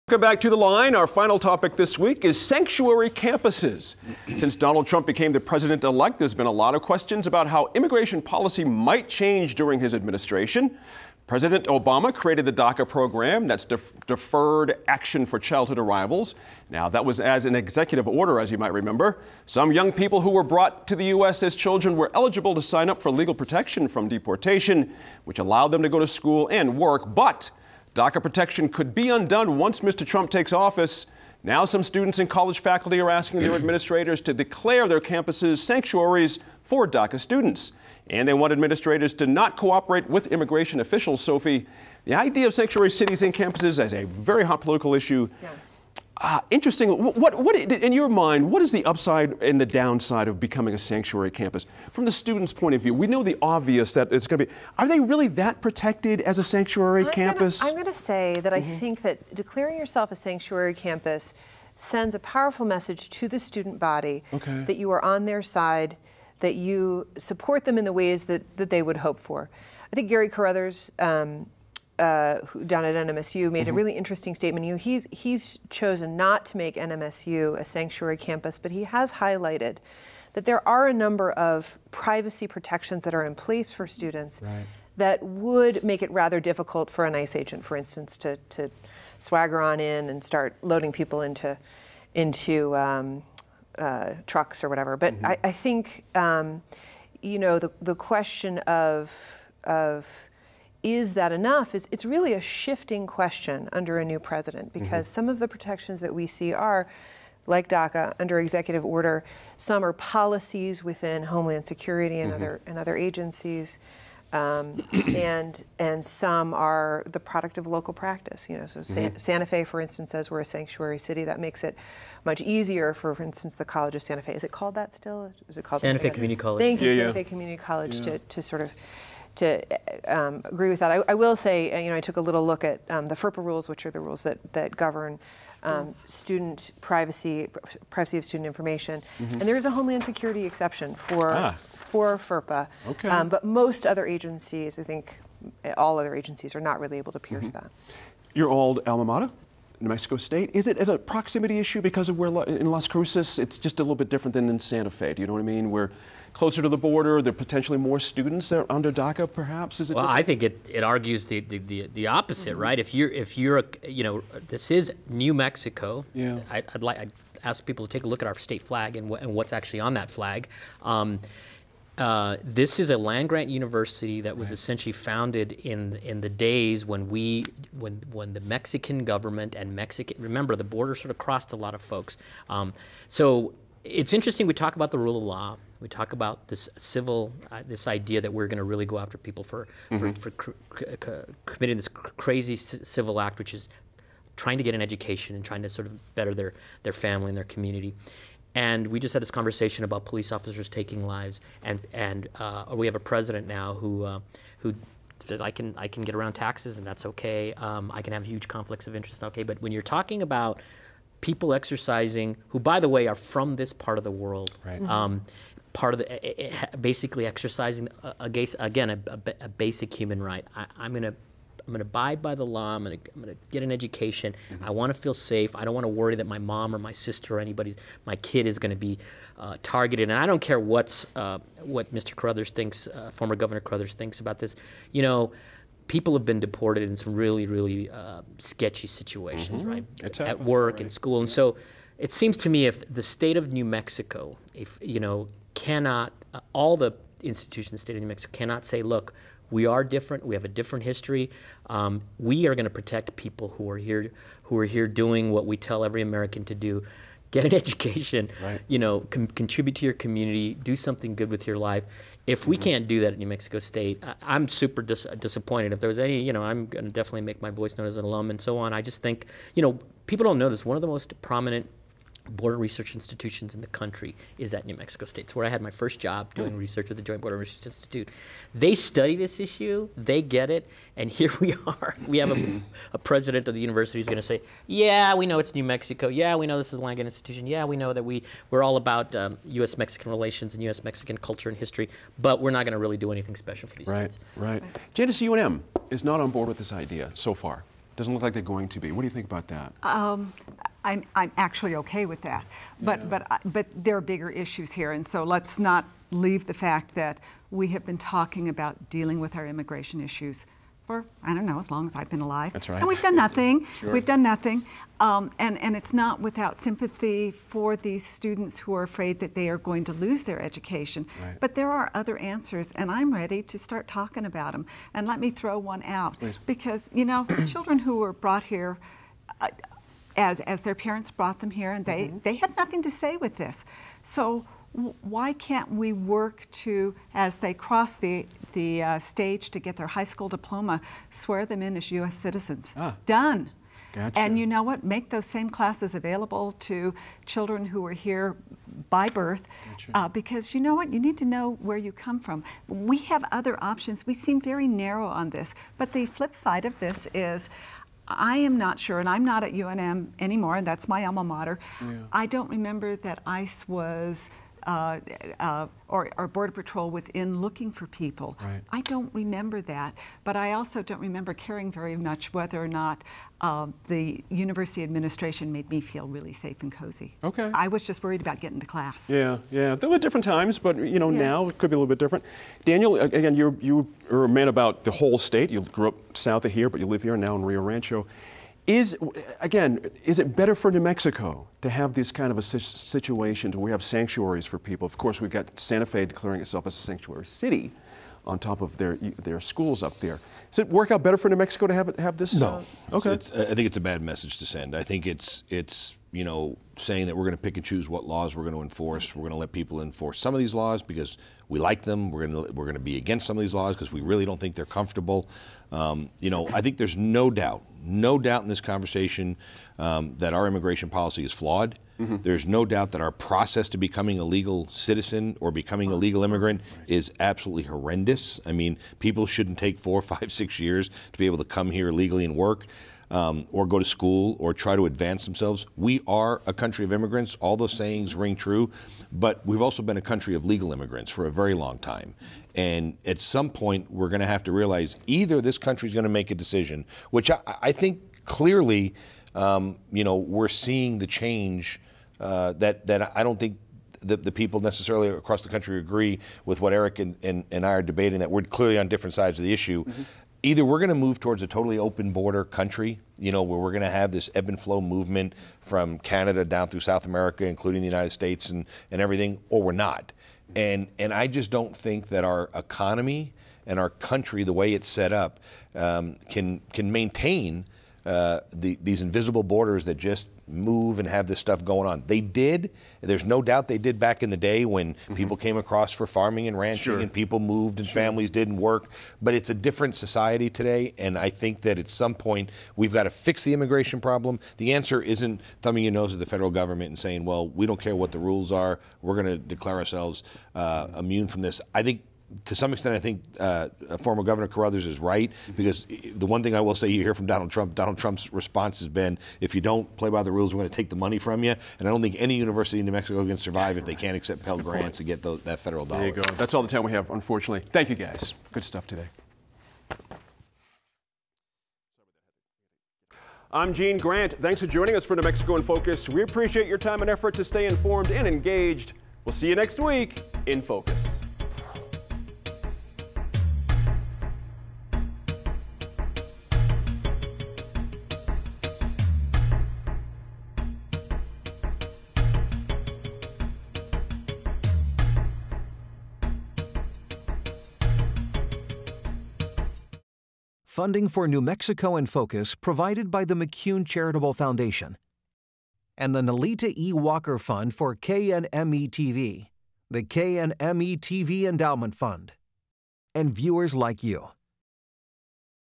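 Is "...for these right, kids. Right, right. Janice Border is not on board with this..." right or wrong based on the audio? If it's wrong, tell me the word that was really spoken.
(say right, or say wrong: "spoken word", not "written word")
wrong: "UNM", not "Border".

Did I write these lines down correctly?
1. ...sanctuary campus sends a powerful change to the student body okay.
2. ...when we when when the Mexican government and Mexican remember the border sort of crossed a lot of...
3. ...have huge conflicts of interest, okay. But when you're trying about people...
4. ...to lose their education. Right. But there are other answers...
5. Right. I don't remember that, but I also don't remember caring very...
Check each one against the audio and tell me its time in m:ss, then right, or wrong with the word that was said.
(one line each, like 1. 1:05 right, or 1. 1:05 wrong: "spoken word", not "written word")
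1. 1:00 wrong: "message", not "change"
2. 2:56 right
3. 3:28 wrong: "talking", not "trying"
4. 5:19 right
5. 6:08 right.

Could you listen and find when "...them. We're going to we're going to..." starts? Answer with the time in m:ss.
6:51.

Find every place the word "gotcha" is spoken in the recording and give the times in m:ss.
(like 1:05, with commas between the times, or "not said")
5:43, 5:49.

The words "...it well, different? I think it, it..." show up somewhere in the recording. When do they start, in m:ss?
2:39.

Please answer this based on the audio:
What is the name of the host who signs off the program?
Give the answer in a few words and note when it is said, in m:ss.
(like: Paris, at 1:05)
Gene Grant, at 8:43.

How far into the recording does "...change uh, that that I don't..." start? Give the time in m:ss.
7:31.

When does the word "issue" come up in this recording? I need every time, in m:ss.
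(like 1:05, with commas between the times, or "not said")
0:44, 2:31, 4:39, 5:04, 5:10, 7:39.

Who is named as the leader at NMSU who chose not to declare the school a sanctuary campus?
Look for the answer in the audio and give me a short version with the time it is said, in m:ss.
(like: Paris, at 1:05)
Gary Carruthers, at 1:10.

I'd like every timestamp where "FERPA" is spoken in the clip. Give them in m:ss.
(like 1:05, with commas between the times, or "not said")
2:13, 2:22.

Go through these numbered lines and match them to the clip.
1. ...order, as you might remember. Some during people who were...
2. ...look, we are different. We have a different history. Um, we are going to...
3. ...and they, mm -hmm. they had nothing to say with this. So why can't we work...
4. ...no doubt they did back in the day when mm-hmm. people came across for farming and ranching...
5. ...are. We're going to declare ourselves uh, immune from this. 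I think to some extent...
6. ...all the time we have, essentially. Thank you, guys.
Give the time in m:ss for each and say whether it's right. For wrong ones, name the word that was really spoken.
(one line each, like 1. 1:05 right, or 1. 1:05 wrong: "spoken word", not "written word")
1. 0:18 wrong: "young", not "during"
2. 4:08 right
3. 5:31 right
4. 8:03 right
5. 8:18 right
6. 8:36 wrong: "unfortunately", not "essentially".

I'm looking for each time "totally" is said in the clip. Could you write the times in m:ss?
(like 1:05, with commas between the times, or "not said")
7:41.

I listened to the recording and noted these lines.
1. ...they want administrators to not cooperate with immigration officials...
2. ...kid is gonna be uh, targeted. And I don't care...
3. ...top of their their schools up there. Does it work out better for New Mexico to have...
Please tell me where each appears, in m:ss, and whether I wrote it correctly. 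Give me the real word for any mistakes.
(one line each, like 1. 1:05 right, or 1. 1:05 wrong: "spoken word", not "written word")
1. 0:38 right
2. 3:48 right
3. 6:38 right.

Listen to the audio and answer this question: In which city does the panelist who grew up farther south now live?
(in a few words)
Rio Rancho.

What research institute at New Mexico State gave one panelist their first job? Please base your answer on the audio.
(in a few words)
Joint Border Research Institute.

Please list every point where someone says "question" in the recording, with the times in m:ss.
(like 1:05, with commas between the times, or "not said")
0:06, 1:37, 1:43.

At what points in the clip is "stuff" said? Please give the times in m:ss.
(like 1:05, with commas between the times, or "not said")
8:01, 8:38.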